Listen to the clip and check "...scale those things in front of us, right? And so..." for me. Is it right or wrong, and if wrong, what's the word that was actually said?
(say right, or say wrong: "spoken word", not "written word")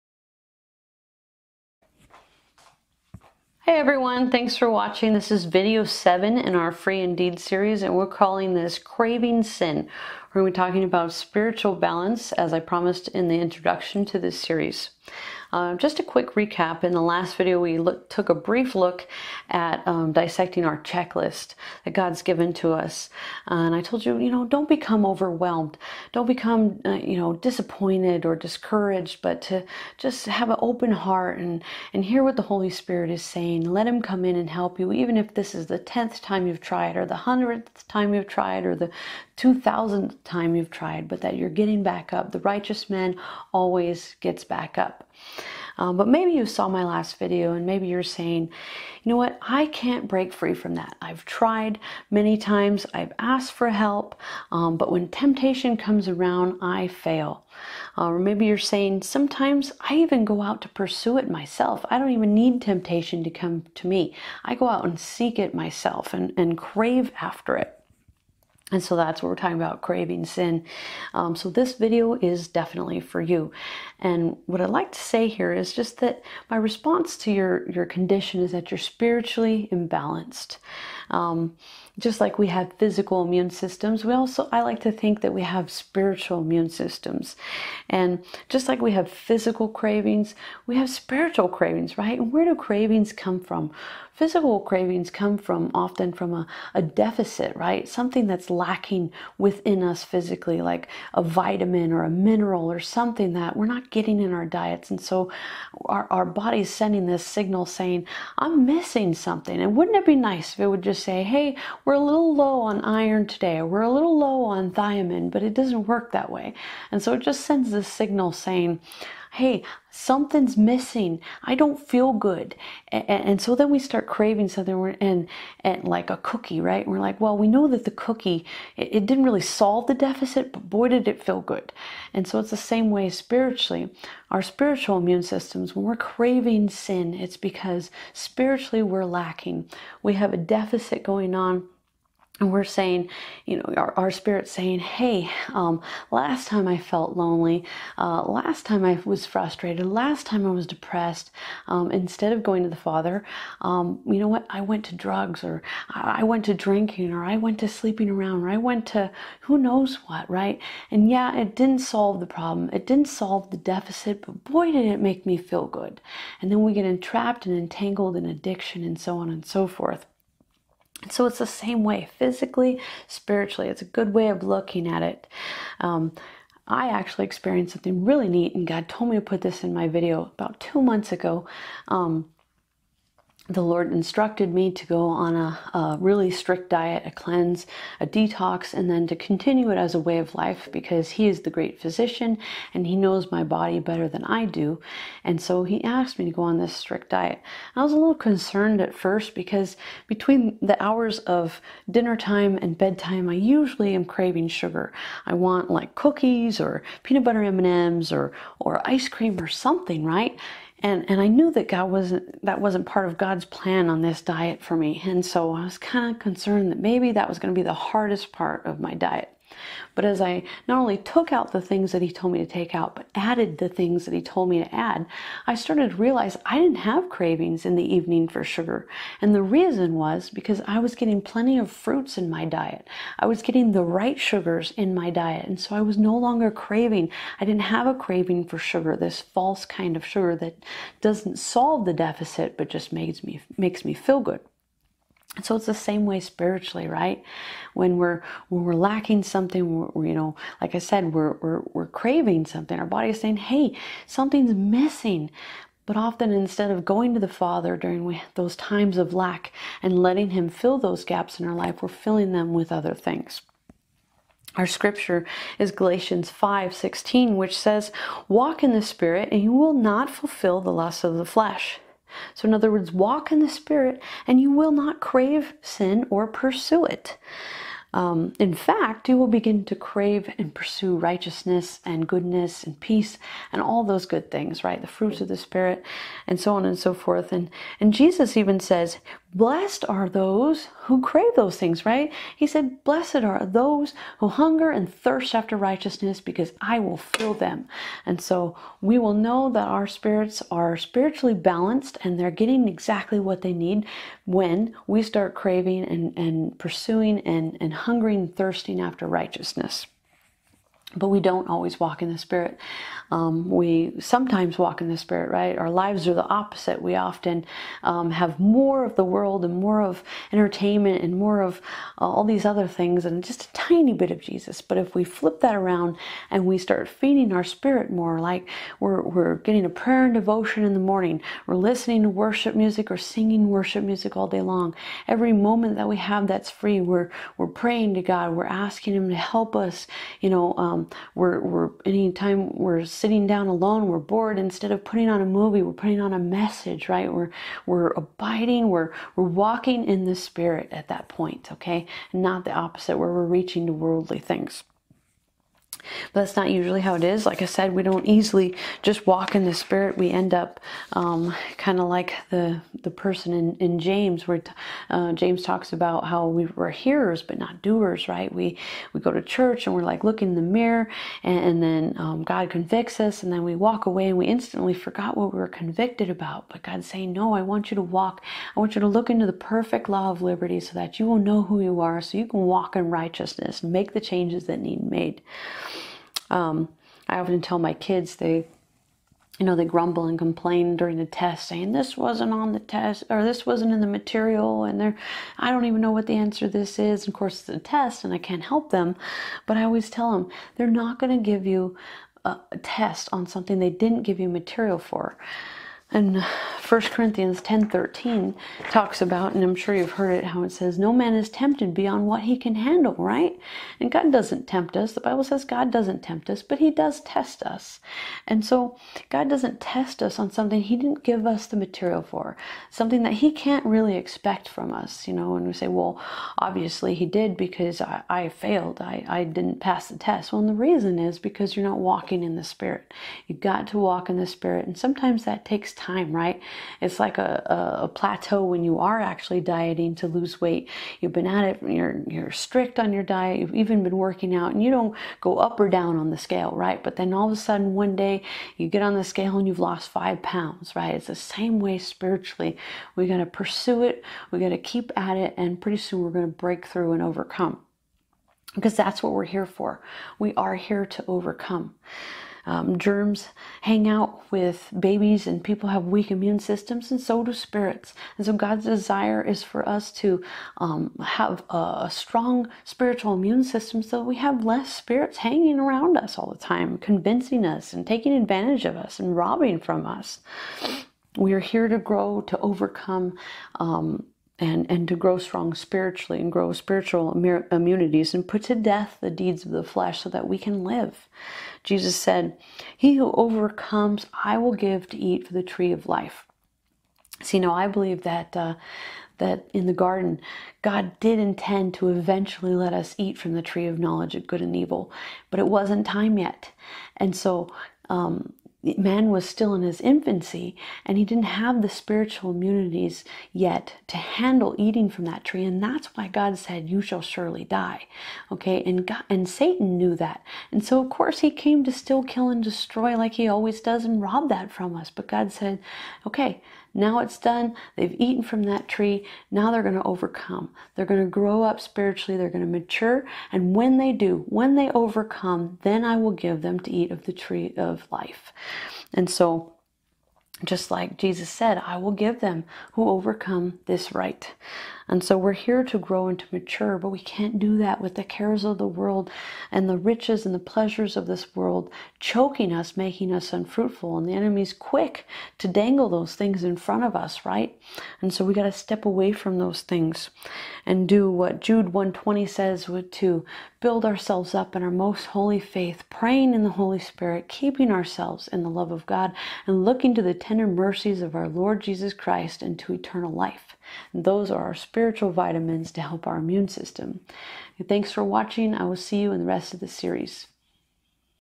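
wrong: "dangle", not "scale".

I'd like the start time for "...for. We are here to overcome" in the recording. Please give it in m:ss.
7:39.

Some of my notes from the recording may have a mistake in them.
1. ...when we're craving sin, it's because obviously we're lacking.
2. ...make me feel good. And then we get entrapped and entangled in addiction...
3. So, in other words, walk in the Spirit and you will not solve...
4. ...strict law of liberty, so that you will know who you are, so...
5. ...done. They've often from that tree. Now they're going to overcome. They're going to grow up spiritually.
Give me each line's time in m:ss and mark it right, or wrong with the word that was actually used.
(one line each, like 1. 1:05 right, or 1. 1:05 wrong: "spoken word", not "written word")
1. 2:15 wrong: "spiritually", not "obviously"
2. 2:44 right
3. 4:32 wrong: "crave", not "solve"
4. 6:19 wrong: "perfect", not "strict"
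5. 8:47 wrong: "eaten", not "often".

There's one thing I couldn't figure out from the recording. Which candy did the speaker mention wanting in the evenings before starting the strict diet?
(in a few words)
peanut butter M&Ms.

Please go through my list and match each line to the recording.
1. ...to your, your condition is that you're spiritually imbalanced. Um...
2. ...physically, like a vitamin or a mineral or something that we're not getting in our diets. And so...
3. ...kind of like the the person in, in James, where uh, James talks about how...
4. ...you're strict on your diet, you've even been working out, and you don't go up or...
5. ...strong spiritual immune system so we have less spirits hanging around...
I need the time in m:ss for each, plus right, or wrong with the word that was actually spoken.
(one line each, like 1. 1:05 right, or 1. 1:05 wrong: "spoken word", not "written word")
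1. 1:17 right
2. 1:40 right
3. 6:01 right
4. 7:22 right
5. 7:51 right.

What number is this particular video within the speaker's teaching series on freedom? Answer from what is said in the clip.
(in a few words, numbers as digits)
7.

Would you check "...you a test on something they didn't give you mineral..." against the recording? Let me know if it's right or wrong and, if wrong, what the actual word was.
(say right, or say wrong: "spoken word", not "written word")
wrong: "material", not "mineral".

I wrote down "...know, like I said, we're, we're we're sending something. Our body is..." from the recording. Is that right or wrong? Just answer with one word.
wrong.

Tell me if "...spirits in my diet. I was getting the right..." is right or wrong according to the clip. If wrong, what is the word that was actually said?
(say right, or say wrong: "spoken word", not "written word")
wrong: "fruits", not "spirits".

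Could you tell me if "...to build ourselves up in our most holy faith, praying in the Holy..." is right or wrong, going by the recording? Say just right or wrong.
right.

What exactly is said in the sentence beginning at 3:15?
And so He asked me to go on this strict diet.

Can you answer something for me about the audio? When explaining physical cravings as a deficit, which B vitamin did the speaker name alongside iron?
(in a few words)
thiamine.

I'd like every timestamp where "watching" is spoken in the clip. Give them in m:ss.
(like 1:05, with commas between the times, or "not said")
0:04, 9:38.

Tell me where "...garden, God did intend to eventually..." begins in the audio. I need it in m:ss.
8:19.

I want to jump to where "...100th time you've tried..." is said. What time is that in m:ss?
0:37.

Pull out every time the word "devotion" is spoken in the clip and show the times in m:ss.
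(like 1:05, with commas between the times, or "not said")
5:30.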